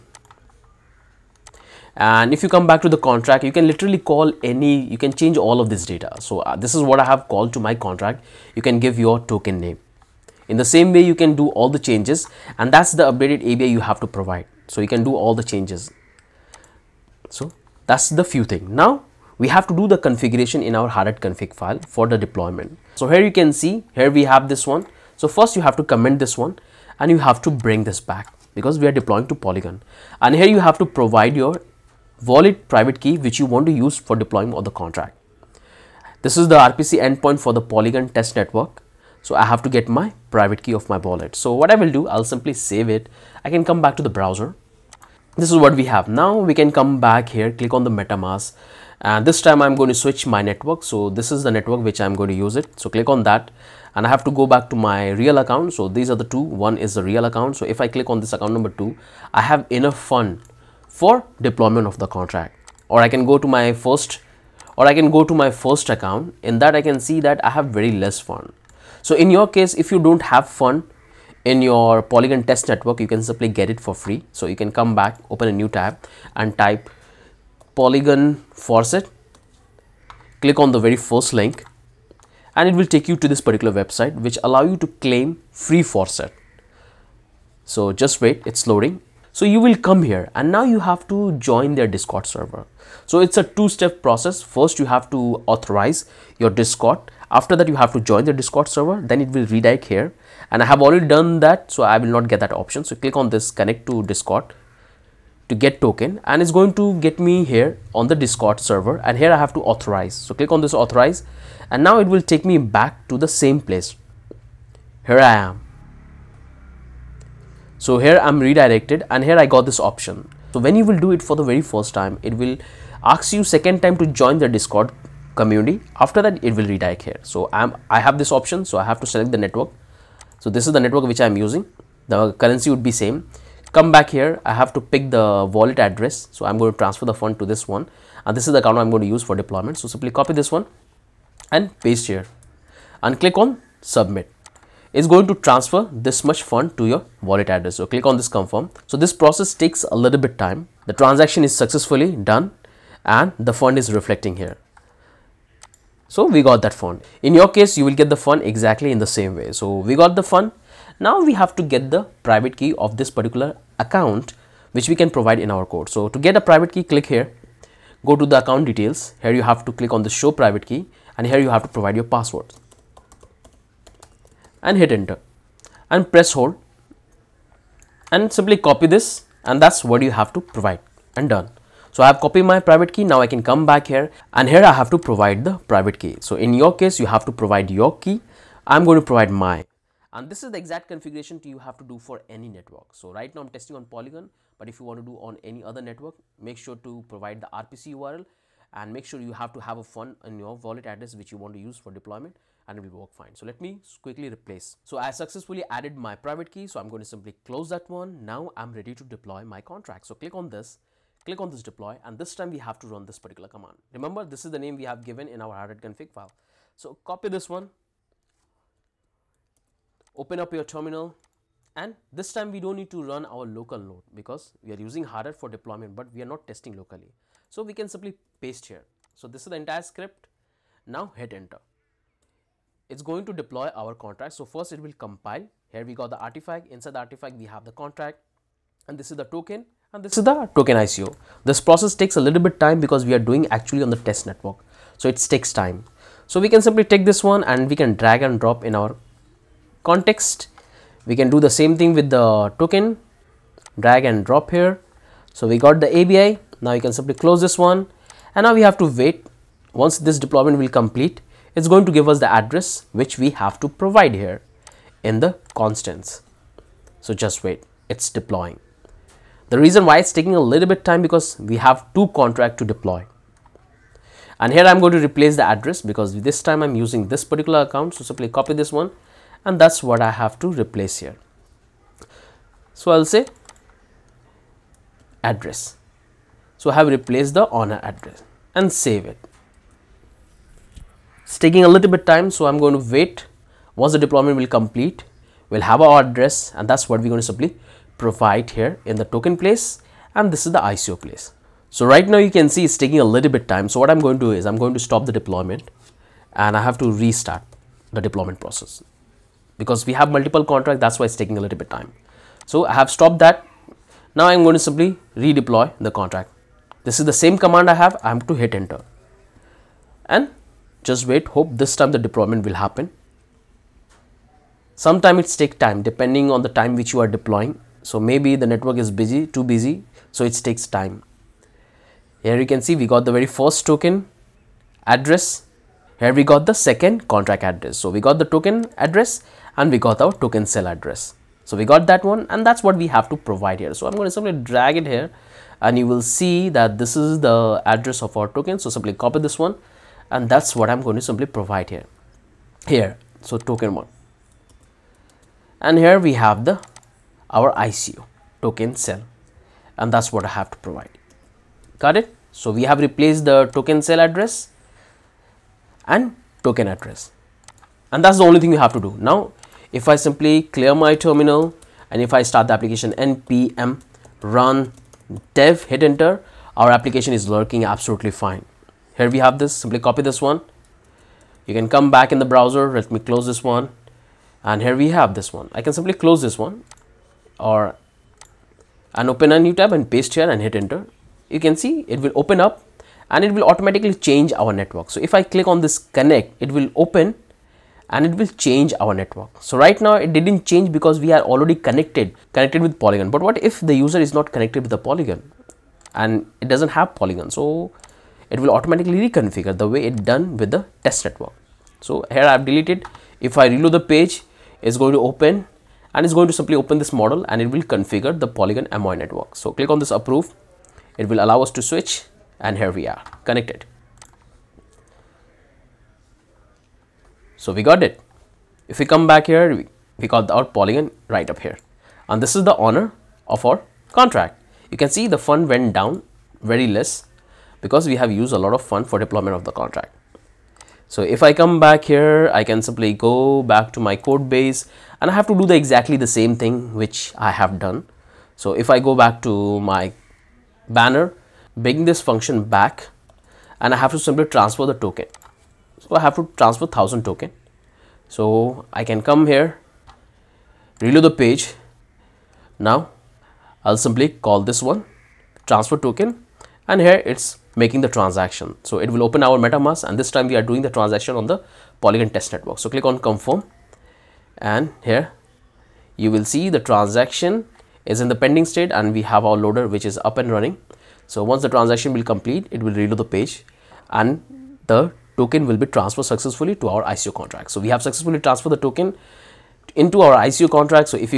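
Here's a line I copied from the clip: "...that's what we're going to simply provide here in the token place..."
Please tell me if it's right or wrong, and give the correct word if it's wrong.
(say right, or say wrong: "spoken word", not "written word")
right.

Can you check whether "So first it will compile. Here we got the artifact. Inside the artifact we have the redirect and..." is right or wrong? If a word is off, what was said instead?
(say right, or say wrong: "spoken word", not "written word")
wrong: "contract", not "redirect".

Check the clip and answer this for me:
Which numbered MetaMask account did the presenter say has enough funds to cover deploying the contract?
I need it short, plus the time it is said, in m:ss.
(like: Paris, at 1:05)
Account number 2, at 0:58.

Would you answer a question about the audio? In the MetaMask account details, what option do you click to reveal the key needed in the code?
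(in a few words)
Show private key.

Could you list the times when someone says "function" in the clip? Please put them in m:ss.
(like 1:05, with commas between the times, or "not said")
7:32.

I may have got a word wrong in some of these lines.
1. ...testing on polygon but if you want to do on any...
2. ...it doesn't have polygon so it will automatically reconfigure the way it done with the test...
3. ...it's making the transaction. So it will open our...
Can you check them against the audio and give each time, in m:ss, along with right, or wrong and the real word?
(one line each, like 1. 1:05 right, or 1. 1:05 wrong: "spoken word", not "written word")
1. 3:13 right
2. 6:46 right
3. 7:47 right.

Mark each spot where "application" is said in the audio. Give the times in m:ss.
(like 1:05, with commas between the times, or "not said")
6:12, 6:16.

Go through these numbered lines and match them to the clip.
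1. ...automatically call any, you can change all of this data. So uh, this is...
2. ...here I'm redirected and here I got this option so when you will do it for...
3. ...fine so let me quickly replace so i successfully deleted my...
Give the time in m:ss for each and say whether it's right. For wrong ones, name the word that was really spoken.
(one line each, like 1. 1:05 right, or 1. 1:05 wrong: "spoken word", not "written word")
1. 0:03 wrong: "literally", not "automatically"
2. 1:57 right
3. 3:23 wrong: "added", not "deleted".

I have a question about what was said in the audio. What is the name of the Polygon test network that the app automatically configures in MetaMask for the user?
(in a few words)
Polygon Amoy.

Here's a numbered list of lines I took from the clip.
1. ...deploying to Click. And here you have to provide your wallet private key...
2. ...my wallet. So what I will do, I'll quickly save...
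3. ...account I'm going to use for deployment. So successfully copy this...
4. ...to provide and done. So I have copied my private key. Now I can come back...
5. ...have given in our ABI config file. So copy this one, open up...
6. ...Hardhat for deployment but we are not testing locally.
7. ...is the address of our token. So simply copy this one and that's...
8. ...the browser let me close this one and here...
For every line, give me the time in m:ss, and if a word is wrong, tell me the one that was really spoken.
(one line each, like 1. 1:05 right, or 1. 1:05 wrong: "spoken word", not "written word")
1. 0:28 wrong: "Polygon", not "Click"
2. 0:40 wrong: "simply", not "quickly"
3. 2:18 wrong: "simply", not "successfully"
4. 3:00 right
5. 3:34 wrong: "Hardhat", not "ABI"
6. 3:45 right
7. 5:46 right
8. 6:22 right.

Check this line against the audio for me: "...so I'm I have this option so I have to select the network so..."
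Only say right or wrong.
right.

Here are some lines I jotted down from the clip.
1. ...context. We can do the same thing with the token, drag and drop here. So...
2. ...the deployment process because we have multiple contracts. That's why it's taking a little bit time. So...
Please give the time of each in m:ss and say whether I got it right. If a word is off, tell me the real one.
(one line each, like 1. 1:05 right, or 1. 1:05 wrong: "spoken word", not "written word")
1. 4:09 right
2. 5:07 right.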